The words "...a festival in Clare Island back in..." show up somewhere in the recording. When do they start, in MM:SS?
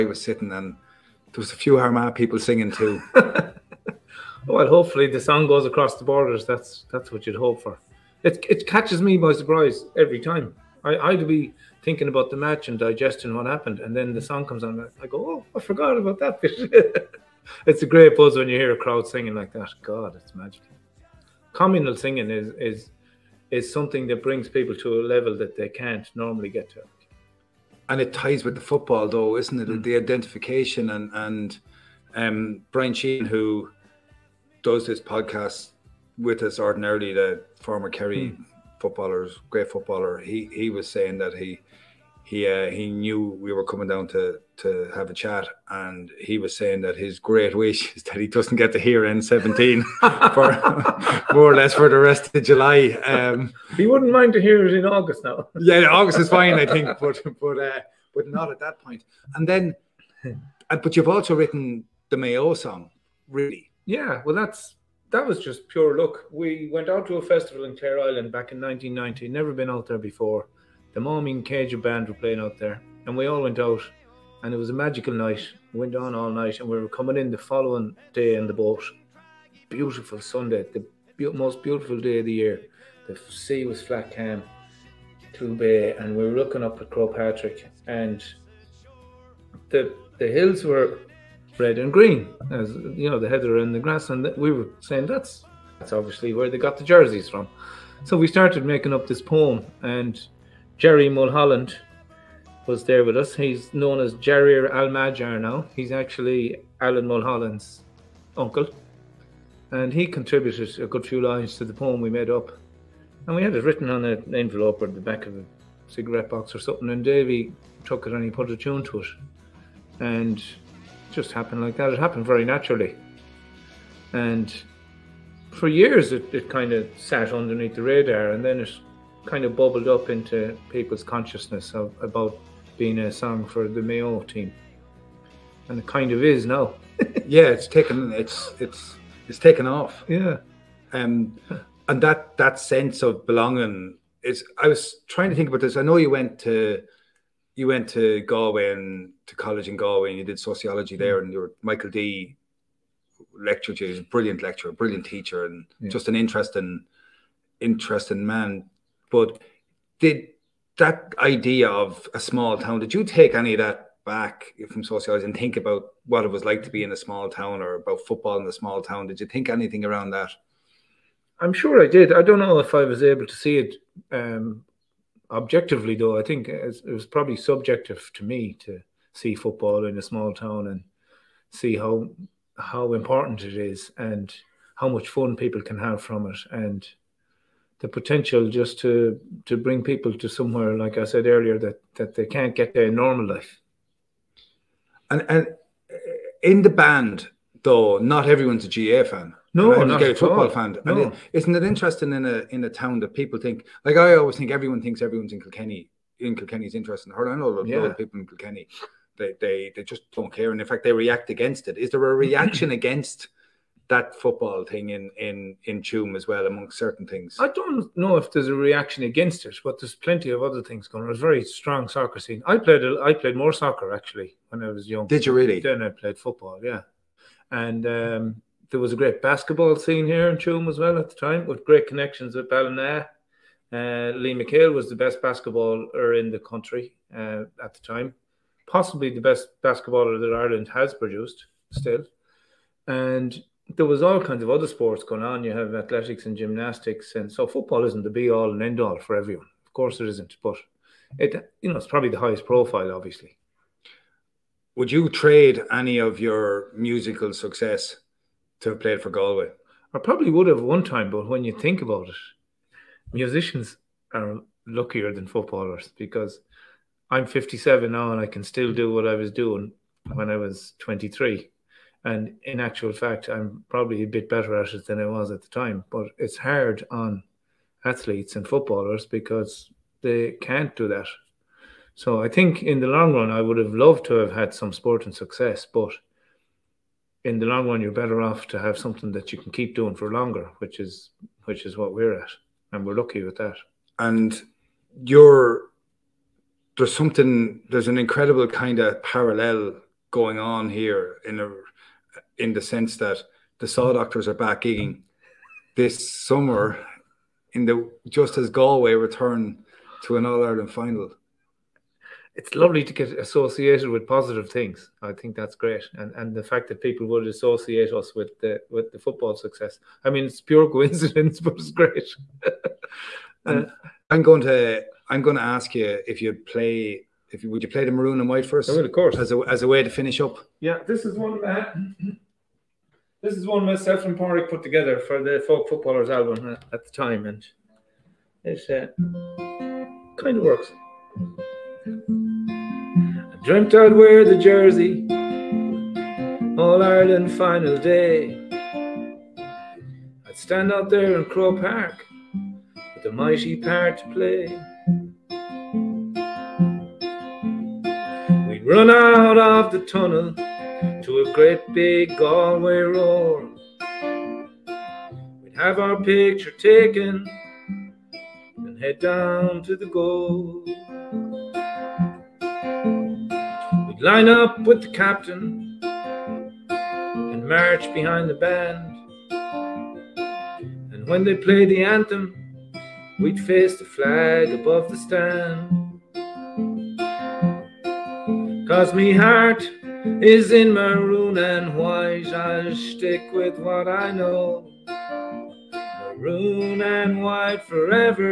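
01:07.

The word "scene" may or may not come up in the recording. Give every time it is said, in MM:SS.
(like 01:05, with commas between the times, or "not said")
03:42, 03:49.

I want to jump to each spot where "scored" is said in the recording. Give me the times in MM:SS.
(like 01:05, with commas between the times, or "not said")
not said.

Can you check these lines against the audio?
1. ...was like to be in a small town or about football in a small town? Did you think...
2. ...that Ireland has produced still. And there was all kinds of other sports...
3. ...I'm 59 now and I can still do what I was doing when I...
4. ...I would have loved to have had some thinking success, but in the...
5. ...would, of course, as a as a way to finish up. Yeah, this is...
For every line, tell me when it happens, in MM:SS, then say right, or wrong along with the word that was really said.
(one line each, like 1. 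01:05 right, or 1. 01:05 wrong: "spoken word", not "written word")
1. 02:46 right
2. 04:00 right
3. 04:27 wrong: "57", not "59"
4. 04:43 wrong: "sporting", not "thinking"
5. 05:28 right.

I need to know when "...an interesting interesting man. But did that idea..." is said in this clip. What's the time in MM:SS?
02:36.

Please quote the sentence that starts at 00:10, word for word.
I, I'd be thinking about the match and digesting what happened, and then the mm.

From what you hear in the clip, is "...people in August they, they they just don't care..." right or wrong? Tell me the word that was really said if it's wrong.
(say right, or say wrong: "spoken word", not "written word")
wrong: "Kilkenny", not "August".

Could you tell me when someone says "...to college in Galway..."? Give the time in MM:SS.
02:29.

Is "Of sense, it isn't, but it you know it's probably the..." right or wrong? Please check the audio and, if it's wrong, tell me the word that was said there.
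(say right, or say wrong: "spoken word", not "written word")
wrong: "course", not "sense".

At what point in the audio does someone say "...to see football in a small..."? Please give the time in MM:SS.
02:58.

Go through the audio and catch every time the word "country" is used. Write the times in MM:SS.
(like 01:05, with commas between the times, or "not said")
03:56.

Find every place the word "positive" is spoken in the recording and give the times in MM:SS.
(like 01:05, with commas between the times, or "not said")
05:14.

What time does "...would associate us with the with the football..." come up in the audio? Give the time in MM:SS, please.
05:17.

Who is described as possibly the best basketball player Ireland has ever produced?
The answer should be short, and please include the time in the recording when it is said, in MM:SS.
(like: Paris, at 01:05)
Liam McHale, at 03:54.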